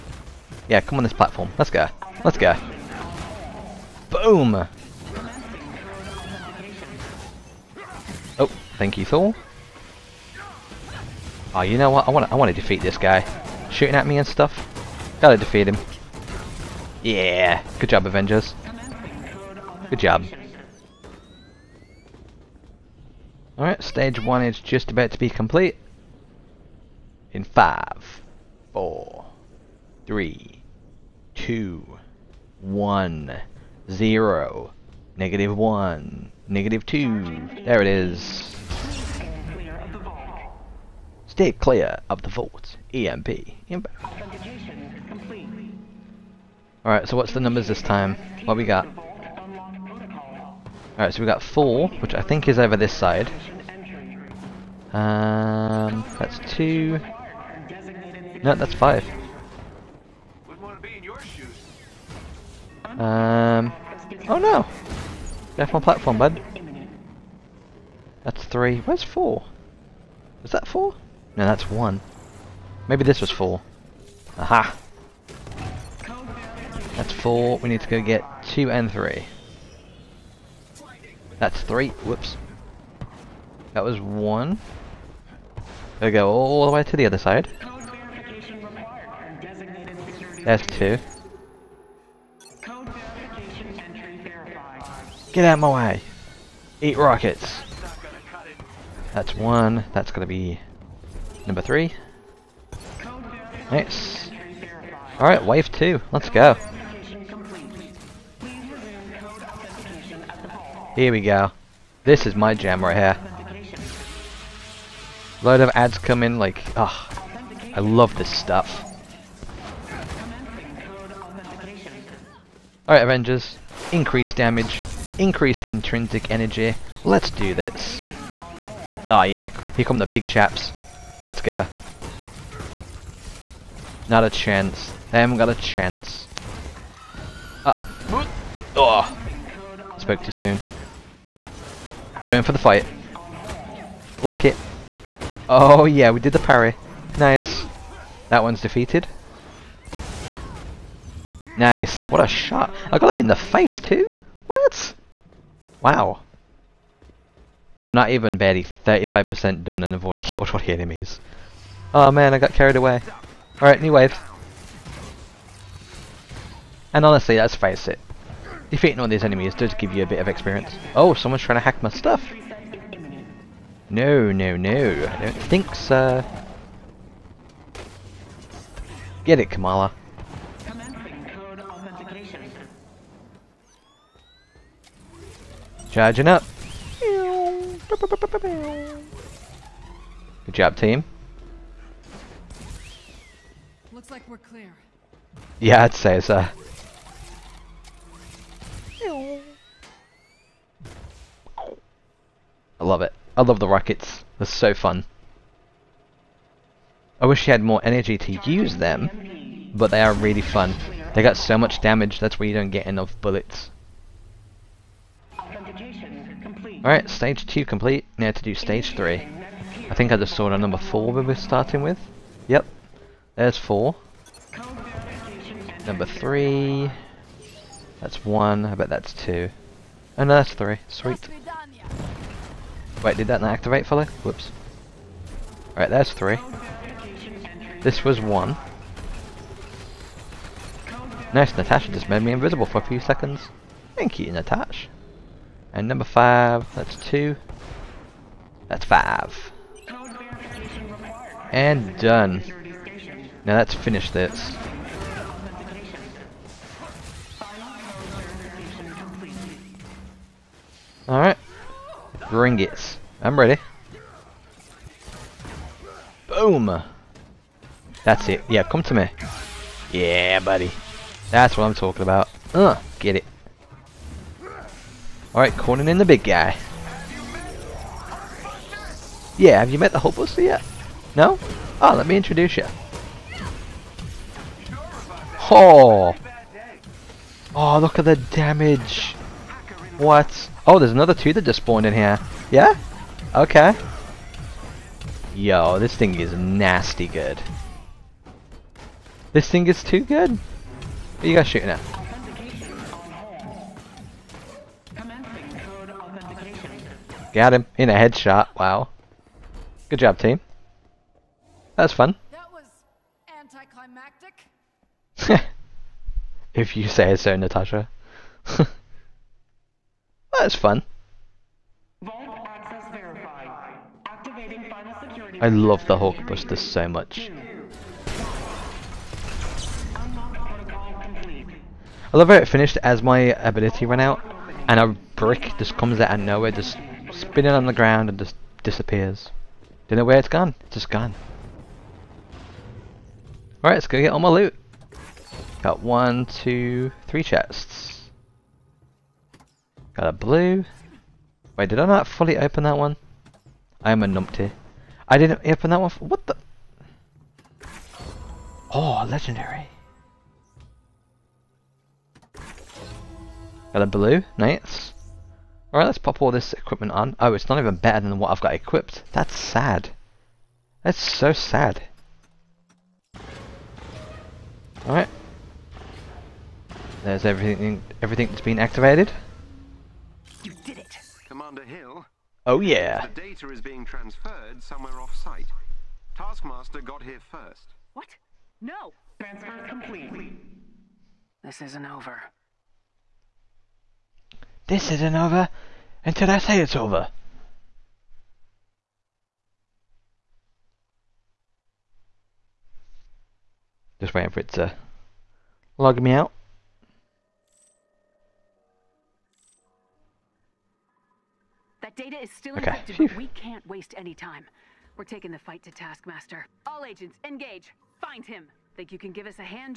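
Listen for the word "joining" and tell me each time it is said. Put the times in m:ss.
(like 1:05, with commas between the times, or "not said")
not said.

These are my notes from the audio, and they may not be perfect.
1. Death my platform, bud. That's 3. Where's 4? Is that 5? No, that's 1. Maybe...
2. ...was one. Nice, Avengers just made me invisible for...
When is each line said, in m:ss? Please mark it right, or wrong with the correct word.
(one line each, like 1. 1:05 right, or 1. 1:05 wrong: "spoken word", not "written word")
1. 1:05 wrong: "4", not "5"
2. 3:58 wrong: "Natasha", not "Avengers".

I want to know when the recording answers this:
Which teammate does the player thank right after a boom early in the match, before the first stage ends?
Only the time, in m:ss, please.
0:09.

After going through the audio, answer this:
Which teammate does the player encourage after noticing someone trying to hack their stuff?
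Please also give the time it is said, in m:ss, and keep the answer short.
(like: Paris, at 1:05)
Kamala, at 2:59.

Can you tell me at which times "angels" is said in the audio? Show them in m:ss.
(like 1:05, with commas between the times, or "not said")
not said.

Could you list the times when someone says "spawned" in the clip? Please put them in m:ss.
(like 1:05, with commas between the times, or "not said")
4:51.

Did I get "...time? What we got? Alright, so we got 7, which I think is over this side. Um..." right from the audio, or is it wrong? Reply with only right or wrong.
wrong.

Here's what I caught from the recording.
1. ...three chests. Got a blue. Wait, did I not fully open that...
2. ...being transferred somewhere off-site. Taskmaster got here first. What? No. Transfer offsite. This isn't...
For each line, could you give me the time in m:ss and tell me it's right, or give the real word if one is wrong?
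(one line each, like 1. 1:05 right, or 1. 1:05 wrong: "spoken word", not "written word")
1. 5:47 right
2. 6:23 wrong: "complete", not "offsite".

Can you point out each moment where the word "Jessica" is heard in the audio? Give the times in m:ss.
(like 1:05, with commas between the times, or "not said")
not said.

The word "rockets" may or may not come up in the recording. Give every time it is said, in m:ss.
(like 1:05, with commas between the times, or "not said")
1:36, 3:23.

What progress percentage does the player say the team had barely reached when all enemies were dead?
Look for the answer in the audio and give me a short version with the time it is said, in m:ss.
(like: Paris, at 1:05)
35%, at 2:38.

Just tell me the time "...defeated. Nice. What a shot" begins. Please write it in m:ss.
2:28.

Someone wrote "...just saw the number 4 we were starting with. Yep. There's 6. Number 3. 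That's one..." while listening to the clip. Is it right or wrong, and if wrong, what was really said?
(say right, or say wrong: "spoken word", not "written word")
wrong: "4", not "6".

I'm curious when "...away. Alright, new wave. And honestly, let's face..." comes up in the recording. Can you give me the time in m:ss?
2:42.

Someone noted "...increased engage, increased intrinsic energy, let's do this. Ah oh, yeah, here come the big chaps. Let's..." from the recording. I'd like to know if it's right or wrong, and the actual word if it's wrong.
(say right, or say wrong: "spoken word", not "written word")
wrong: "damage", not "engage".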